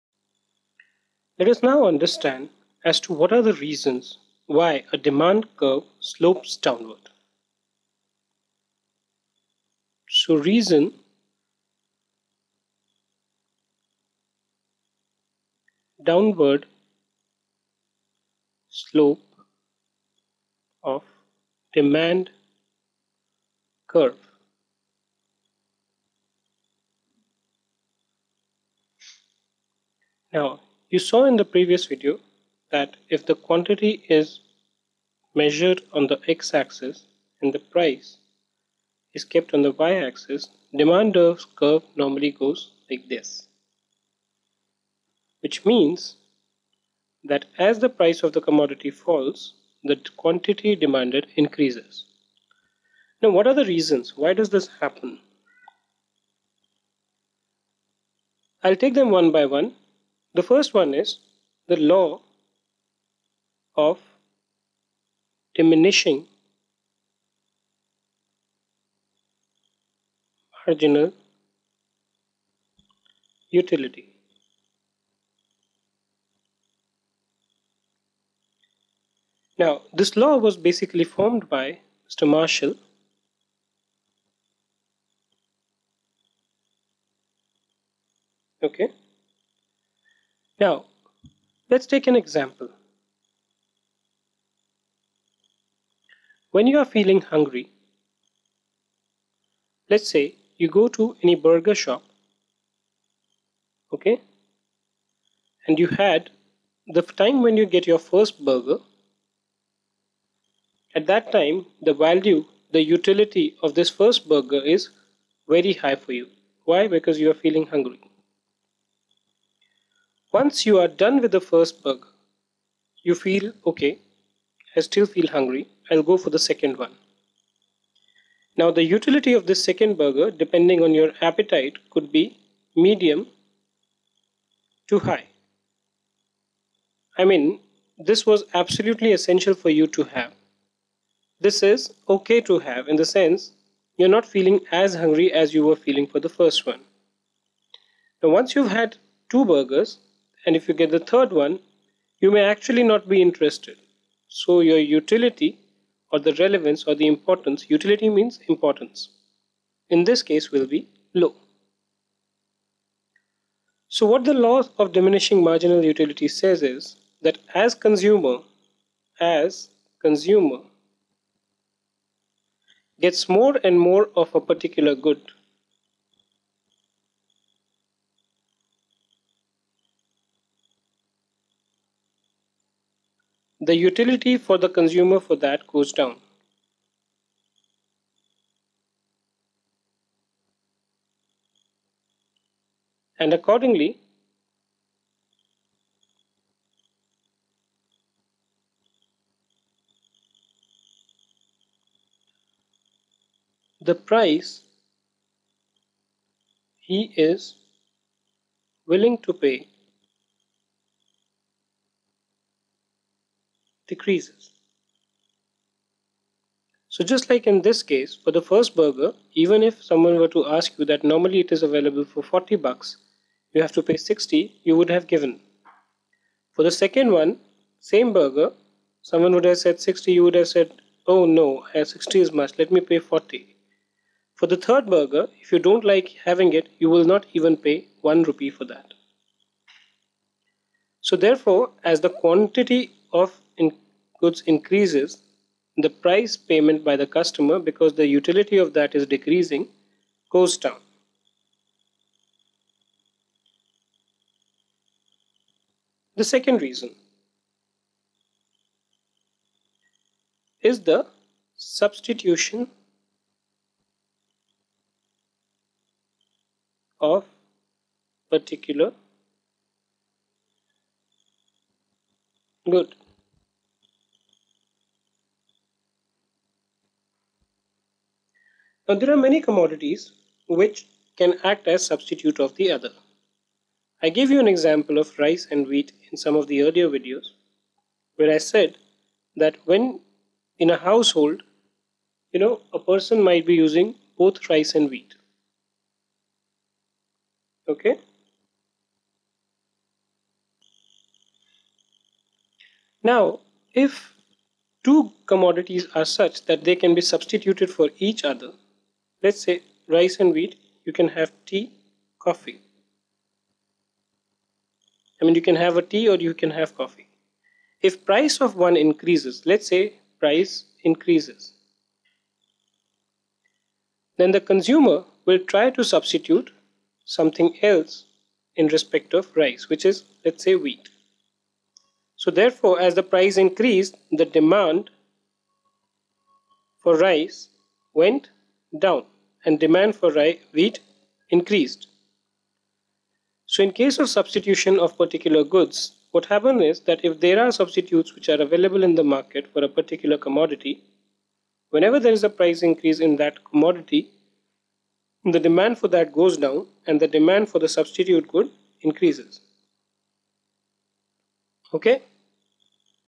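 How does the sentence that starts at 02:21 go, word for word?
This is okay to have in the sense you're not feeling as hungry as you were feeling for the first one.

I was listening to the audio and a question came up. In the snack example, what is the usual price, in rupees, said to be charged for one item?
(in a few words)
40.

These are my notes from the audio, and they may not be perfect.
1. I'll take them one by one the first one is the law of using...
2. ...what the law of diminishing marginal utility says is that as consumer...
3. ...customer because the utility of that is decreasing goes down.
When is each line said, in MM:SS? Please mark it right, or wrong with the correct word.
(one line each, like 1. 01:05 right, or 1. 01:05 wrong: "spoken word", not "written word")
1. 00:58 wrong: "diminishing", not "using"
2. 02:44 right
3. 04:07 right.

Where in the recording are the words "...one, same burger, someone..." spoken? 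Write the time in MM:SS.
03:47.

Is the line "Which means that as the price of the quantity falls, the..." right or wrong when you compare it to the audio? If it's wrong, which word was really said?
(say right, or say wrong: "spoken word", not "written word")
wrong: "commodity", not "quantity".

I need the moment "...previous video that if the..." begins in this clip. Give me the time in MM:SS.
00:31.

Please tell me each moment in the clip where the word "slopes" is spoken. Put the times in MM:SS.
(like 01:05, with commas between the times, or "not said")
00:05, 00:18.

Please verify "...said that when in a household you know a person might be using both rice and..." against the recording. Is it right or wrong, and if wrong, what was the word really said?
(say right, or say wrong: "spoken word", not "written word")
right.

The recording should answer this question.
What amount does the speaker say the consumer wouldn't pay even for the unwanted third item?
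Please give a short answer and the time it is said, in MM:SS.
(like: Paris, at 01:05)
1 rupee, at 03:58.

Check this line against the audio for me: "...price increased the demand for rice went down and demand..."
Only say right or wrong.
right.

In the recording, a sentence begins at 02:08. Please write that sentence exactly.
Now the utility of this second burger depending on your appetite could be medium to high.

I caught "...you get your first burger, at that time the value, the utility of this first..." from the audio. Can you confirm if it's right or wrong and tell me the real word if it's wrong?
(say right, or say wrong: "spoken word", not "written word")
right.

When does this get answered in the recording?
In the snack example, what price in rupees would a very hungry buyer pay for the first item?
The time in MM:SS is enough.
03:43.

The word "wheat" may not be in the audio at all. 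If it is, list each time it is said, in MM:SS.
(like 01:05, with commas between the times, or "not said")
04:45, 04:54, 05:10, 05:30, 05:40.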